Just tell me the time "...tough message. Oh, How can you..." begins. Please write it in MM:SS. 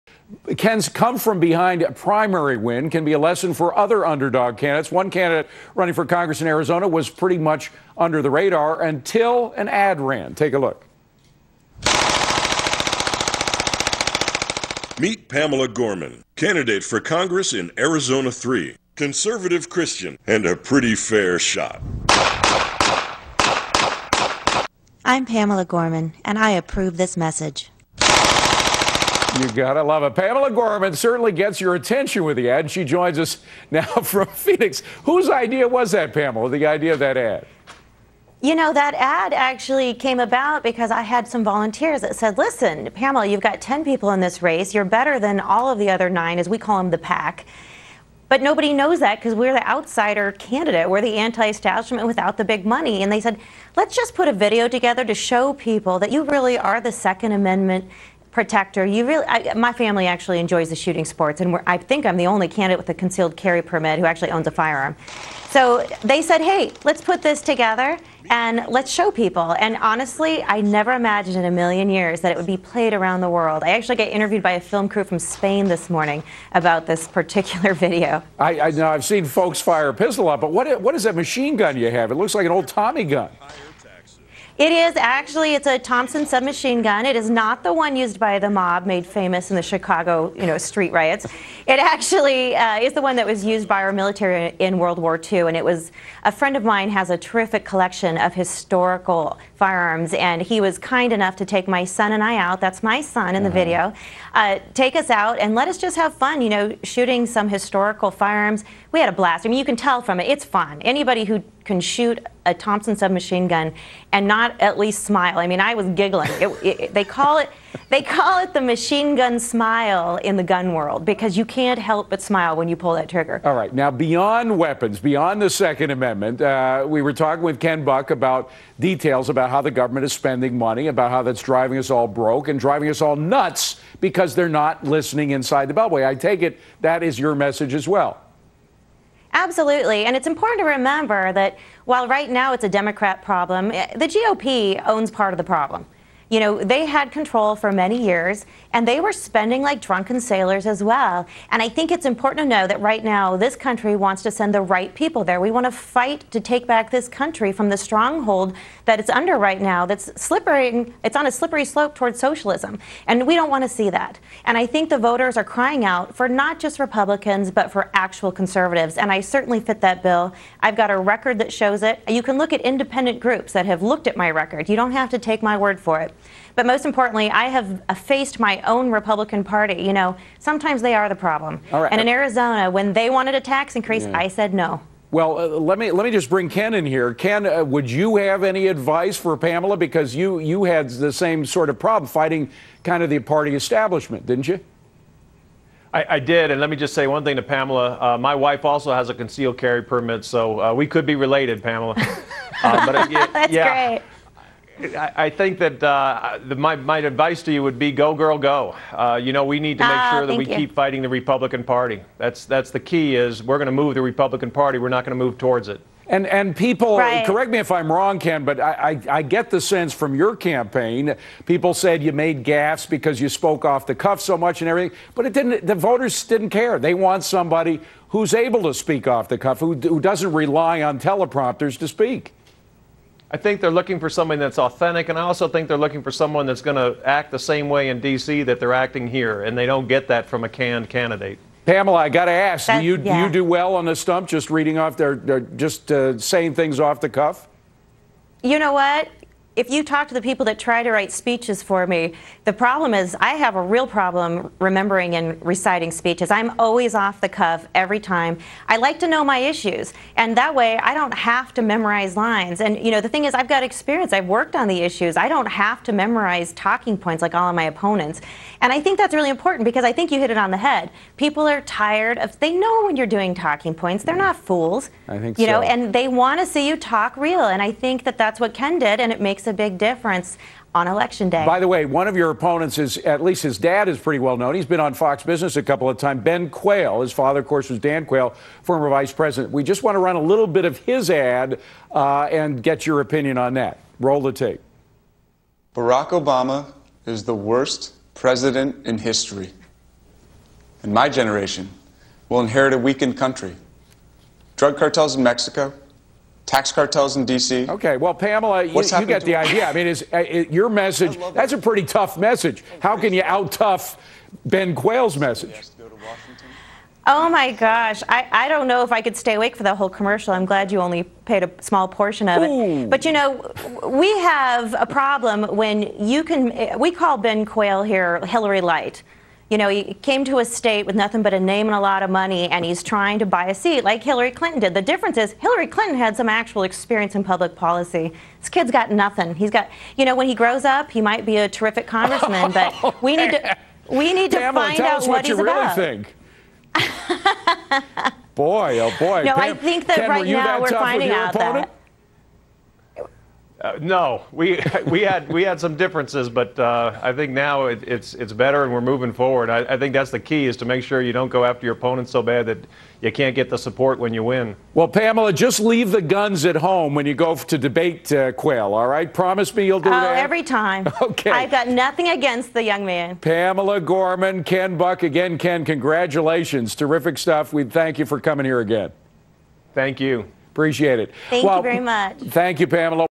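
05:11.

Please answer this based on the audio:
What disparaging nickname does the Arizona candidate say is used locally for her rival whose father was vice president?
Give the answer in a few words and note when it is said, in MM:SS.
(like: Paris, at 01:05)
Hillary Light, at 05:28.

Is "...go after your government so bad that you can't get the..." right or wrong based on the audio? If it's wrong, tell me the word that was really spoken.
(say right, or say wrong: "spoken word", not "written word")
wrong: "opponent", not "government".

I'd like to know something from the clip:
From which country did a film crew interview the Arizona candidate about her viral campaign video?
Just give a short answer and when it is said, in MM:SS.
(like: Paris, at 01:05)
Spain, at 01:15.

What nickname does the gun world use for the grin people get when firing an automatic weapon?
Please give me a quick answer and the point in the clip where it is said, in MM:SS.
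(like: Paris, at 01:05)
machine gun smile, at 01:58.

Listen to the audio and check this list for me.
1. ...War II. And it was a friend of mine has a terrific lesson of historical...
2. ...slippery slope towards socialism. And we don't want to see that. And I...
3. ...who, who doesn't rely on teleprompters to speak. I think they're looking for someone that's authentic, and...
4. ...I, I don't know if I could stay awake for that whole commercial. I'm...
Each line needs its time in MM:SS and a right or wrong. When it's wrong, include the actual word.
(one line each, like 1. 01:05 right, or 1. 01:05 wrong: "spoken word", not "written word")
1. 01:34 wrong: "collection", not "lesson"
2. 02:41 right
3. 03:49 right
4. 05:18 right.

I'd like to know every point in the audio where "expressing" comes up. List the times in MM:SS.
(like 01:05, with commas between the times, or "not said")
not said.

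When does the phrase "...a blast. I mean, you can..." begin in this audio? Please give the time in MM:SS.
01:49.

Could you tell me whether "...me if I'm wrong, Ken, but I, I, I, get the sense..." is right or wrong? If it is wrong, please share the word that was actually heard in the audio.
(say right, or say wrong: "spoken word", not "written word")
right.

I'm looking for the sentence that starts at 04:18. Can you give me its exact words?
I like to know my issues, and that way I don't have to memorize lines.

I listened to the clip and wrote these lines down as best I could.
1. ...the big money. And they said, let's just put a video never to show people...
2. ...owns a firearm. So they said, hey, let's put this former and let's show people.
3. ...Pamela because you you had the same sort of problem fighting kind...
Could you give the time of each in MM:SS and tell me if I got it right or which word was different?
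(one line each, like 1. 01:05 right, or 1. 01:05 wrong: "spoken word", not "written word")
1. 00:52 wrong: "together", not "never"
2. 01:04 wrong: "together", not "former"
3. 03:09 right.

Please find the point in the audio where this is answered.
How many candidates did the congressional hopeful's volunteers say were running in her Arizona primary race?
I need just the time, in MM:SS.
00:43.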